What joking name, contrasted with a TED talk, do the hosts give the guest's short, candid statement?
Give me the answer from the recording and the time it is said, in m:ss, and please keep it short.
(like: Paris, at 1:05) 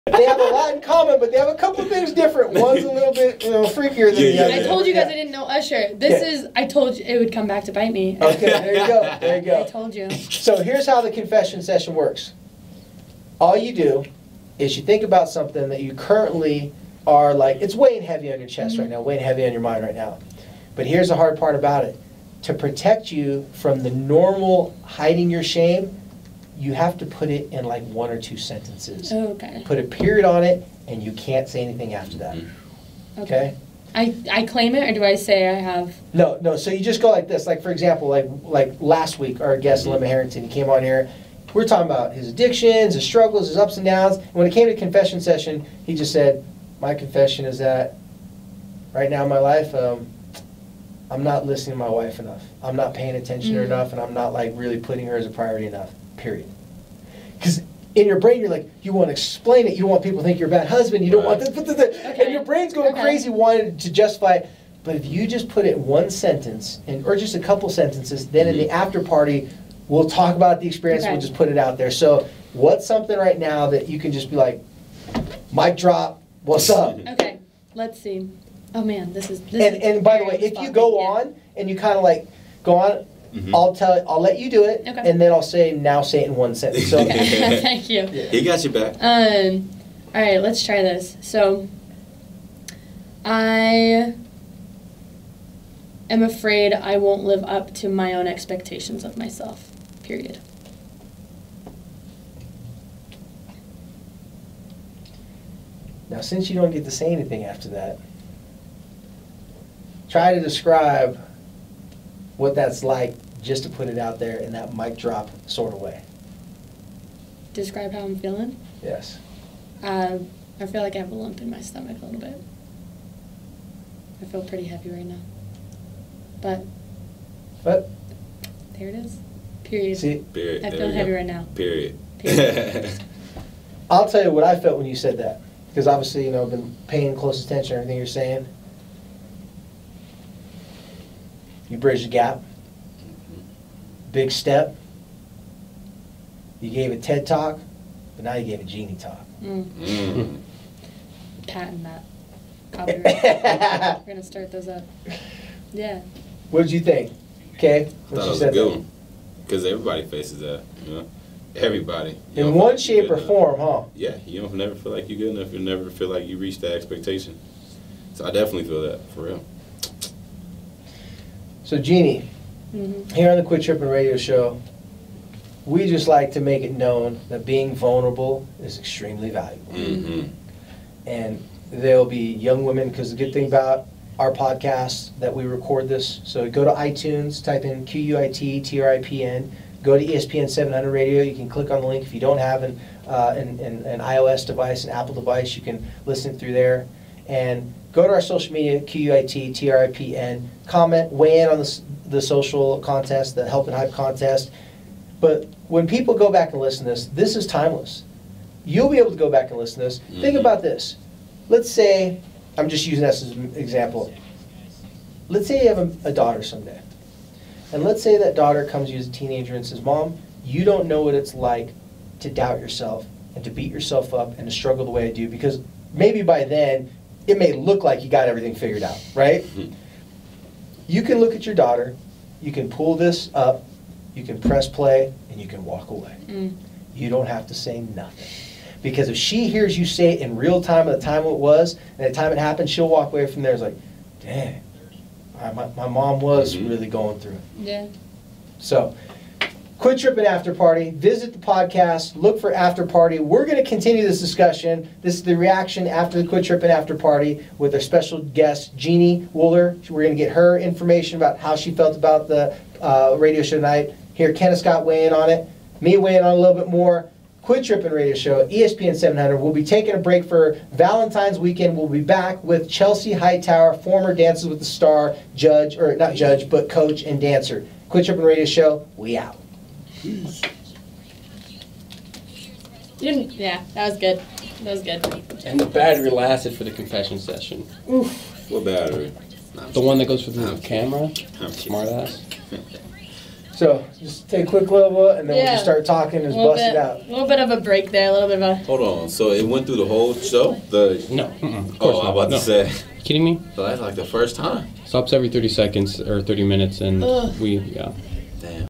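Jeannie talk, at 2:28.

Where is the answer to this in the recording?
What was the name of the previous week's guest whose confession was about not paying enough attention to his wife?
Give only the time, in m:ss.
0:40.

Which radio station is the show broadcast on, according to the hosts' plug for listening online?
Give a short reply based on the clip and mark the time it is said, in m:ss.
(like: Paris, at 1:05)
ESPN 700, at 3:10.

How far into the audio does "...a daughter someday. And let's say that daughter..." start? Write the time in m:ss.
3:36.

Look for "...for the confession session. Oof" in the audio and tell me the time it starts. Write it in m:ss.
4:46.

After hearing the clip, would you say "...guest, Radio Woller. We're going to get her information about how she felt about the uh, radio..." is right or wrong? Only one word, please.
wrong.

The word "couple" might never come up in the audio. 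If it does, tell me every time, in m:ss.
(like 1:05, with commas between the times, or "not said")
0:01, 1:07.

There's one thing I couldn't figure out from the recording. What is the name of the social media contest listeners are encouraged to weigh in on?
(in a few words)
Help and Hype contest.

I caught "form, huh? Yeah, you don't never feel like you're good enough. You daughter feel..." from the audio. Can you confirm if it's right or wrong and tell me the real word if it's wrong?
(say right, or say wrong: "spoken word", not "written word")
wrong: "never", not "daughter".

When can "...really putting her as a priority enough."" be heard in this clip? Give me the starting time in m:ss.
0:54.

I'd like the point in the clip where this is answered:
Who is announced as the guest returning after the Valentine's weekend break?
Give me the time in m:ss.
4:32.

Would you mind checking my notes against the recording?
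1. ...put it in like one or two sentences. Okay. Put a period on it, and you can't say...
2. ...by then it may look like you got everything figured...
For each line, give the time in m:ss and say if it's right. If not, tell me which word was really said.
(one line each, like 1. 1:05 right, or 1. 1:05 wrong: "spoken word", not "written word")
1. 0:27 right
2. 3:46 right.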